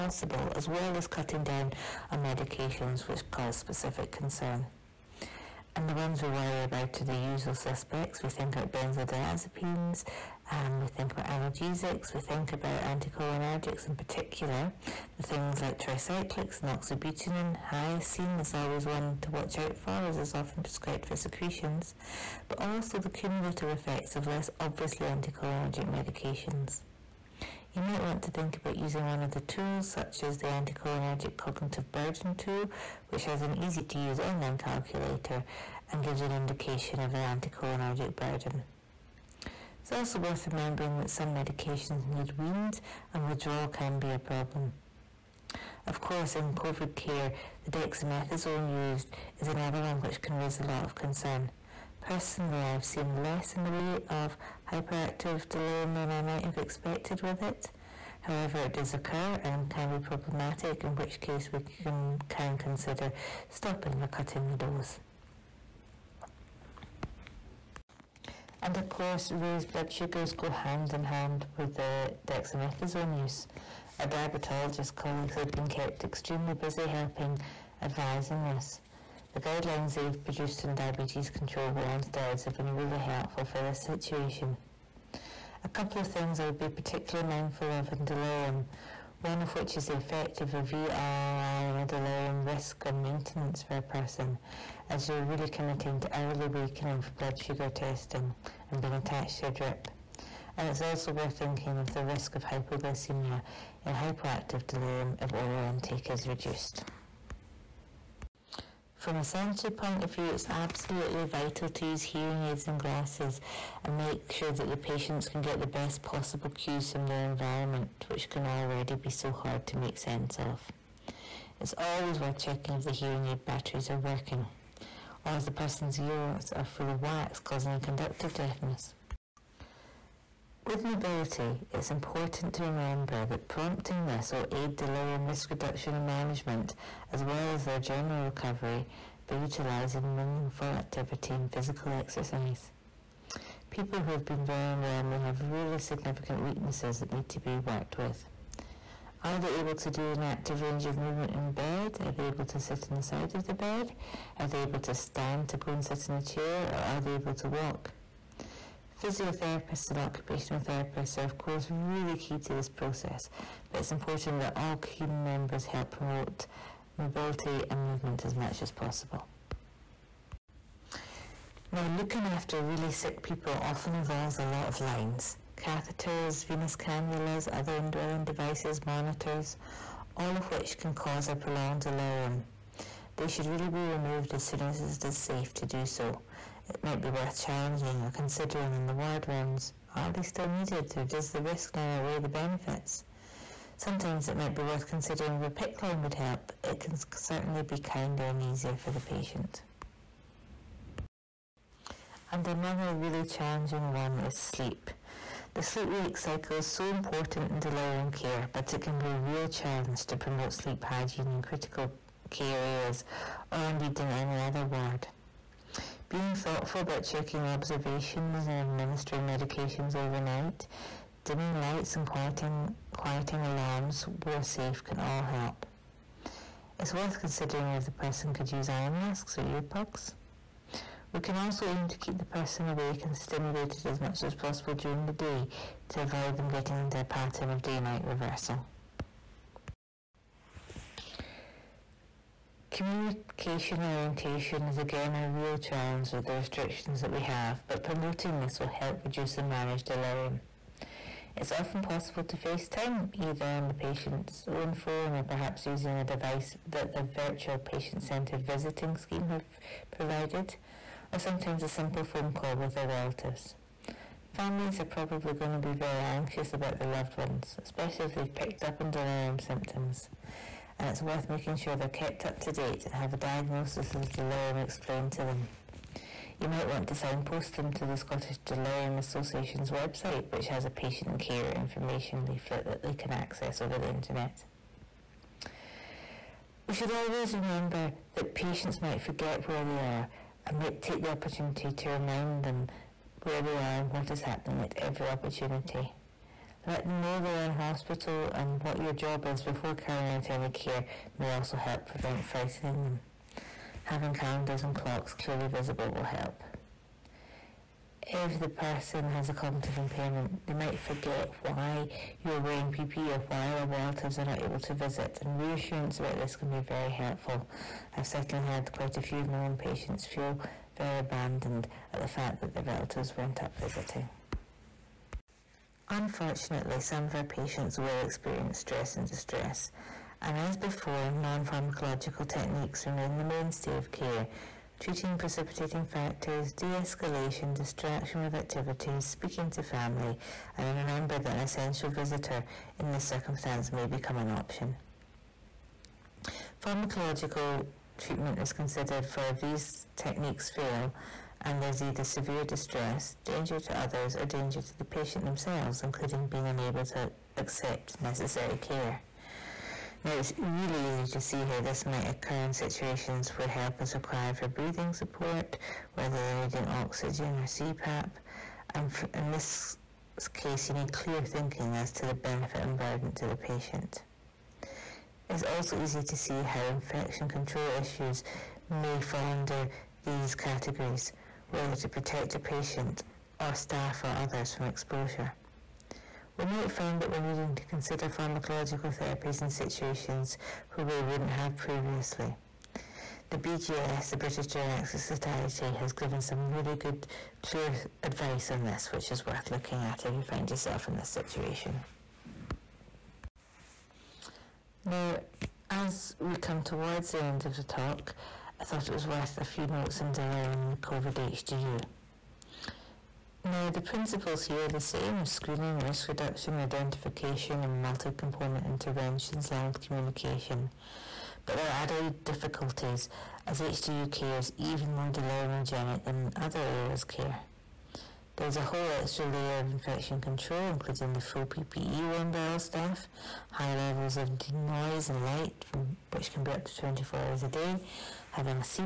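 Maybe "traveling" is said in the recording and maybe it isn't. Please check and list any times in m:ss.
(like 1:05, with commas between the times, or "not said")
not said.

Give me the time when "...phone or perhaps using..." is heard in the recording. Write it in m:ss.
4:14.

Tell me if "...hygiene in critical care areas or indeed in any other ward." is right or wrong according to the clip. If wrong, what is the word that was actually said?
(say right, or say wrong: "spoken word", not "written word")
right.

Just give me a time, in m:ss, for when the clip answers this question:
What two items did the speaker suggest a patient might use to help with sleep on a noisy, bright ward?
3:48.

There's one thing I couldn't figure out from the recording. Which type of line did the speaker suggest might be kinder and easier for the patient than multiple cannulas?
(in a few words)
PICC line.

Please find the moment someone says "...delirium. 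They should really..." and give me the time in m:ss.
3:01.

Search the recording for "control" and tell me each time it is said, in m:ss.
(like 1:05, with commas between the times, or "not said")
1:21, 6:17, 7:10.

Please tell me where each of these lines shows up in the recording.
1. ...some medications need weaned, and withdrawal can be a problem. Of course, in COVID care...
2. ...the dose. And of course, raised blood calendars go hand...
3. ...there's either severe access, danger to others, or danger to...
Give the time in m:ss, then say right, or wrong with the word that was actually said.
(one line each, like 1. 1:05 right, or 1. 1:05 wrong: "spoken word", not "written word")
1. 0:41 right
2. 1:04 wrong: "sugars", not "calendars"
3. 5:51 wrong: "distress", not "access".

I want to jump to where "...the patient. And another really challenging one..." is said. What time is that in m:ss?
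3:18.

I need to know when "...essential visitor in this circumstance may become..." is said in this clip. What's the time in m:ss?
5:41.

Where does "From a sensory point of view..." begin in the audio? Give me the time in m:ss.
1:48.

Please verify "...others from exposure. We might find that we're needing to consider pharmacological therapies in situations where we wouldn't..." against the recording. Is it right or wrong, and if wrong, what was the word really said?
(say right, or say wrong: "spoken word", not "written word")
right.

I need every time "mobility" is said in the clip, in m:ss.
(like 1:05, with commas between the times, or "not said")
2:10, 2:46.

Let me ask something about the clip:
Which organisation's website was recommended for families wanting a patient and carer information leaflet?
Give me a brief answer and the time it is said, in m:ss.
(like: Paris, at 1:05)
Scottish Delirium Association, at 4:37.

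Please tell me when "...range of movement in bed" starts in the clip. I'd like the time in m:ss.
2:30.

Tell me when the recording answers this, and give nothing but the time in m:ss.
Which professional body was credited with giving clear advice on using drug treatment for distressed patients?
6:34.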